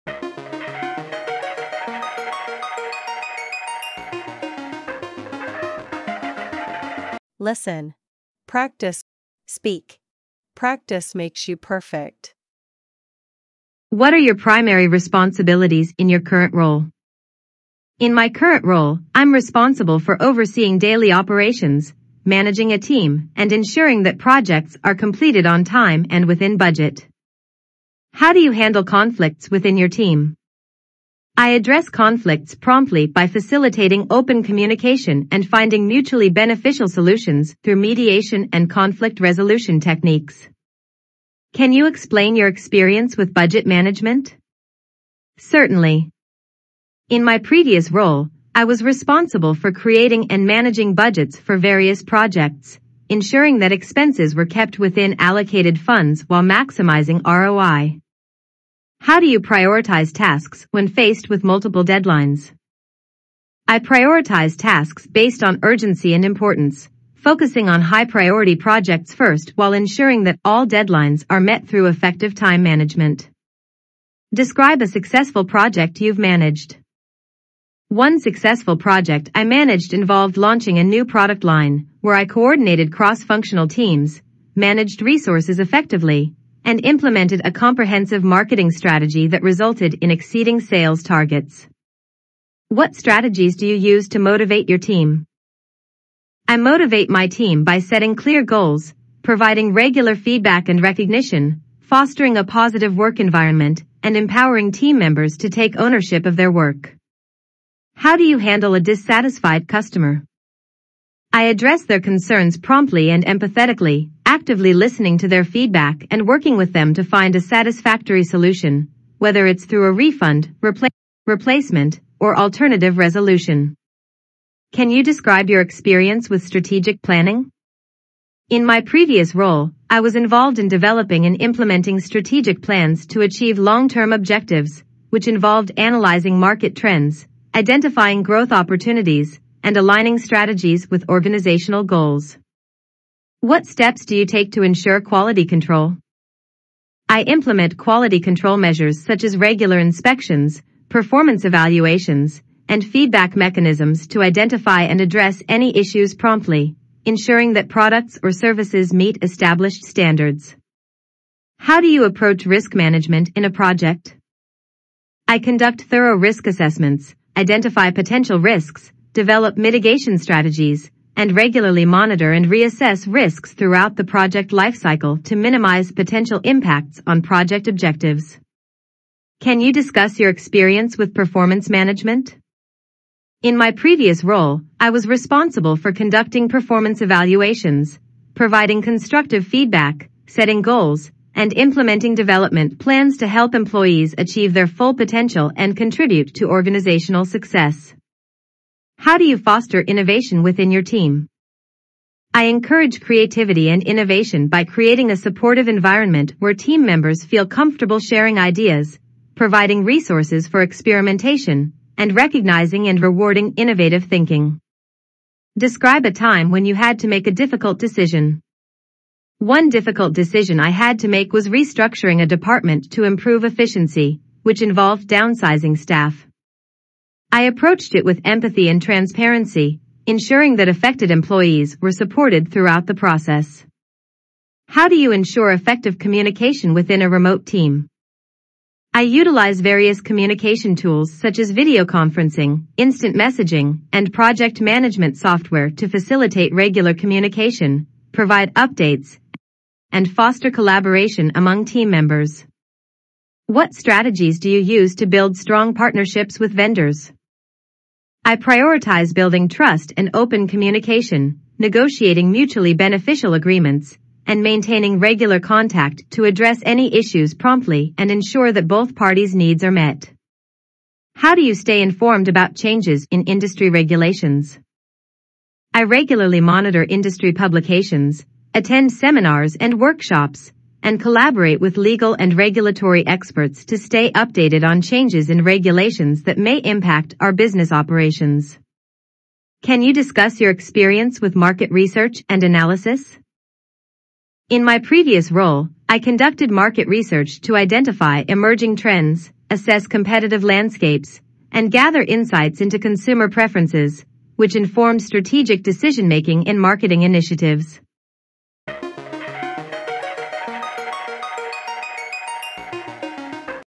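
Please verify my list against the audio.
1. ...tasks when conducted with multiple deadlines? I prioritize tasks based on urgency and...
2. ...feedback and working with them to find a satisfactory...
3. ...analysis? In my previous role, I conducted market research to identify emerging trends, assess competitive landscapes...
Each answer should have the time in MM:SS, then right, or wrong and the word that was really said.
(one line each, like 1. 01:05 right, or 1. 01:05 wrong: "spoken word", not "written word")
1. 01:00 wrong: "faced", not "conducted"
2. 01:55 right
3. 04:52 right.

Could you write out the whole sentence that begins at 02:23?
What steps do you take to ensure quality control?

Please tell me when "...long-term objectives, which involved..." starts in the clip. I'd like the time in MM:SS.
02:13.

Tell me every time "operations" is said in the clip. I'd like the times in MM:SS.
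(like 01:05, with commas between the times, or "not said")
00:21, 04:47.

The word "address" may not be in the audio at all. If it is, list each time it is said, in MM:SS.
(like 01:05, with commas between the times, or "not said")
00:31, 01:51, 02:35, 04:26.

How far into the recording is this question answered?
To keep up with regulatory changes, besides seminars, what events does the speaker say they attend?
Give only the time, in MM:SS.
04:39.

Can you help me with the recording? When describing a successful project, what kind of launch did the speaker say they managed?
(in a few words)
new product line.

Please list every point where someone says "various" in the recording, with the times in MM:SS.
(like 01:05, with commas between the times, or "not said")
00:51, 03:59.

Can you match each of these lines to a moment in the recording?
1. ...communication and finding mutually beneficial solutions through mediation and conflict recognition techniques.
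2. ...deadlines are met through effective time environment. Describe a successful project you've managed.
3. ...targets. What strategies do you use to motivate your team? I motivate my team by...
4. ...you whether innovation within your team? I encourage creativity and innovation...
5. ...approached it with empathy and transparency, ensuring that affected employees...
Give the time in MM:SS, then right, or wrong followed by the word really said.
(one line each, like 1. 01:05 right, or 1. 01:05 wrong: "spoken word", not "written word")
1. 00:34 wrong: "resolution", not "recognition"
2. 01:10 wrong: "management", not "environment"
3. 01:31 right
4. 03:19 wrong: "foster", not "whether"
5. 03:47 right.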